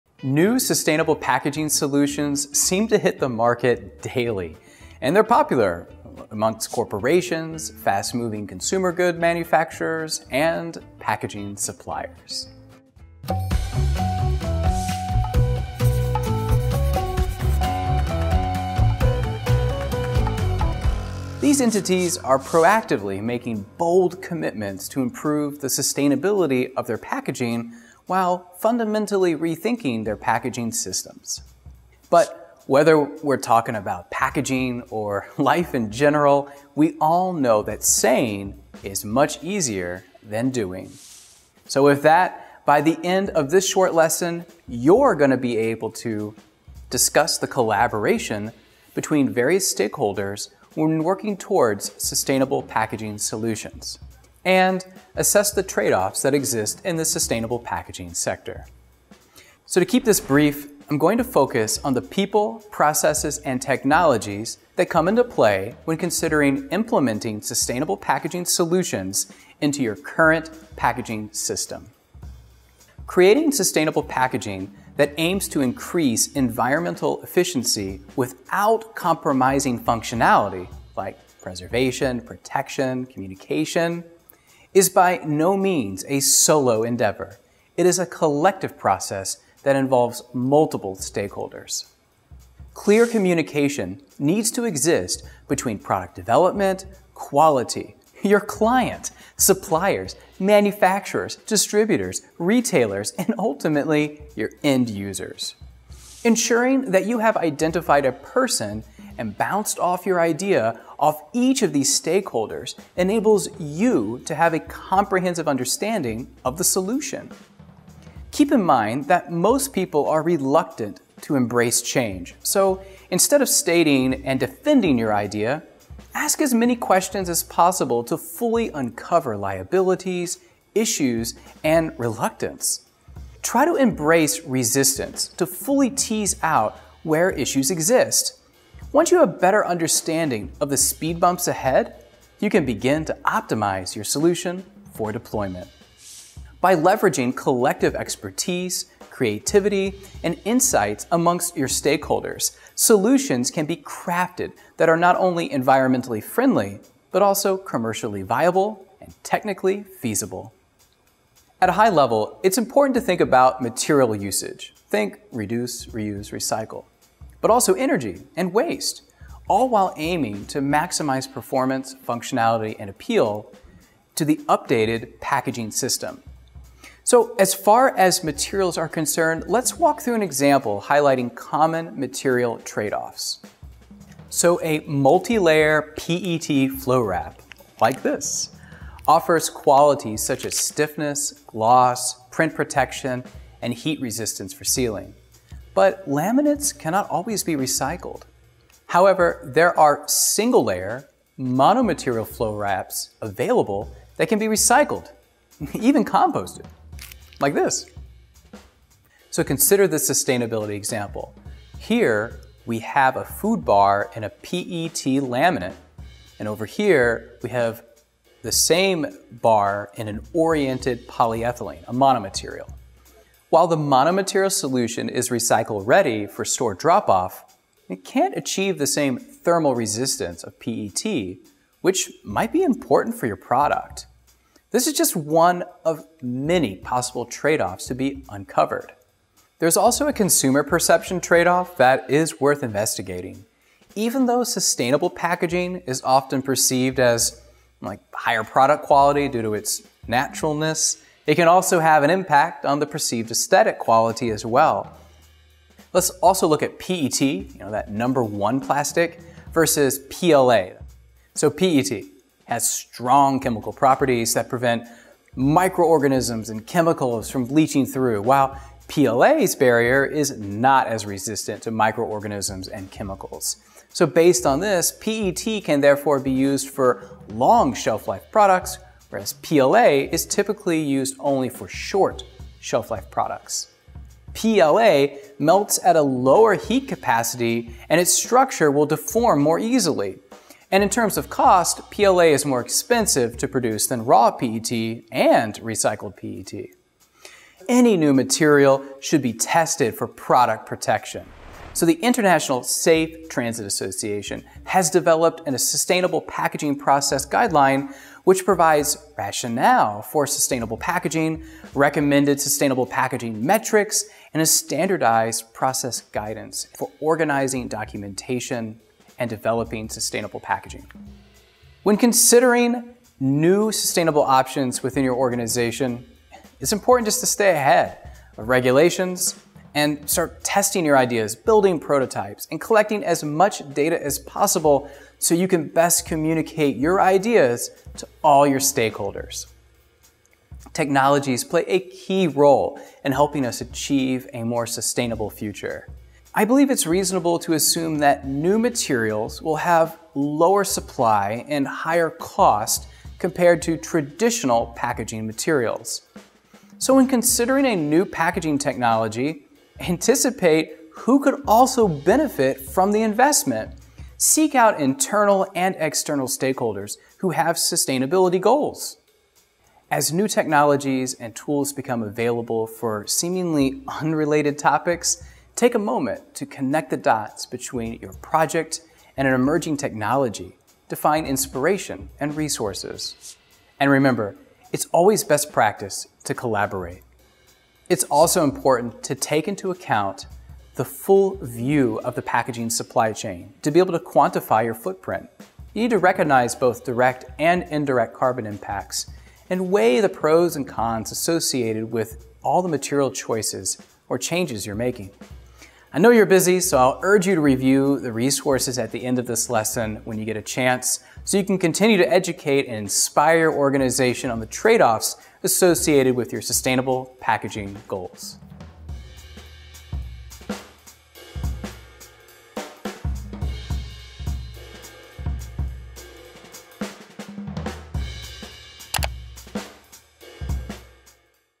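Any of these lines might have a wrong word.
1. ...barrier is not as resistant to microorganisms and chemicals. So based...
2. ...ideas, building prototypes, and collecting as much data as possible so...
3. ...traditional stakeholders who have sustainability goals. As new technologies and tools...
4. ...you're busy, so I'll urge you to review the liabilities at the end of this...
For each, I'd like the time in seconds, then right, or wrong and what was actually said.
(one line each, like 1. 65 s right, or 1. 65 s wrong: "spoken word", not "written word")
1. 269 s right
2. 330 s right
3. 365 s wrong: "external", not "traditional"
4. 406 s wrong: "resources", not "liabilities".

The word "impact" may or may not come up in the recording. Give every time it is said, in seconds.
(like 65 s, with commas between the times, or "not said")
252 s, 398 s.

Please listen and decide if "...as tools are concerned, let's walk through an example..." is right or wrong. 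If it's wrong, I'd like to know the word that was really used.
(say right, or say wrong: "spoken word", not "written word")
wrong: "materials", not "tools".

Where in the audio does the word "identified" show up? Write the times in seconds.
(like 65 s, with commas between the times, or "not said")
107 s.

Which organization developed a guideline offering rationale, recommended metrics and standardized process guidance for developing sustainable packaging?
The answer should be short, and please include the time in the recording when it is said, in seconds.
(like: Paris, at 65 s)
International Safe Transit Association, at 301 s.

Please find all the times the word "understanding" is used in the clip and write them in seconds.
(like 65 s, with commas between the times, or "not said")
115 s, 139 s.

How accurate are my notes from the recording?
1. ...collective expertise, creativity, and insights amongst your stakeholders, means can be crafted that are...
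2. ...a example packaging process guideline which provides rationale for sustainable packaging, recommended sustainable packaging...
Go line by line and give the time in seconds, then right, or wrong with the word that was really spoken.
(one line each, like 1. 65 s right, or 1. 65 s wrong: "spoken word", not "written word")
1. 147 s wrong: "solutions", not "means"
2. 305 s wrong: "sustainable", not "example".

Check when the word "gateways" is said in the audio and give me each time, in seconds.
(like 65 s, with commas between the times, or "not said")
not said.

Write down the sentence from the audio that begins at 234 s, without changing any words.
This is just one of many possible trade-offs to be uncovered.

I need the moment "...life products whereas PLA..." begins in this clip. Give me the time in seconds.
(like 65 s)
278 s.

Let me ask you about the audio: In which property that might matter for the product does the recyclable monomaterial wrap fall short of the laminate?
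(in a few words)
thermal resistance.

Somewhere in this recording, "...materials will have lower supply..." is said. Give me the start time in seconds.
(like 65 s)
348 s.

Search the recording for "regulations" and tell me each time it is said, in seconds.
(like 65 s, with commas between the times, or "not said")
328 s.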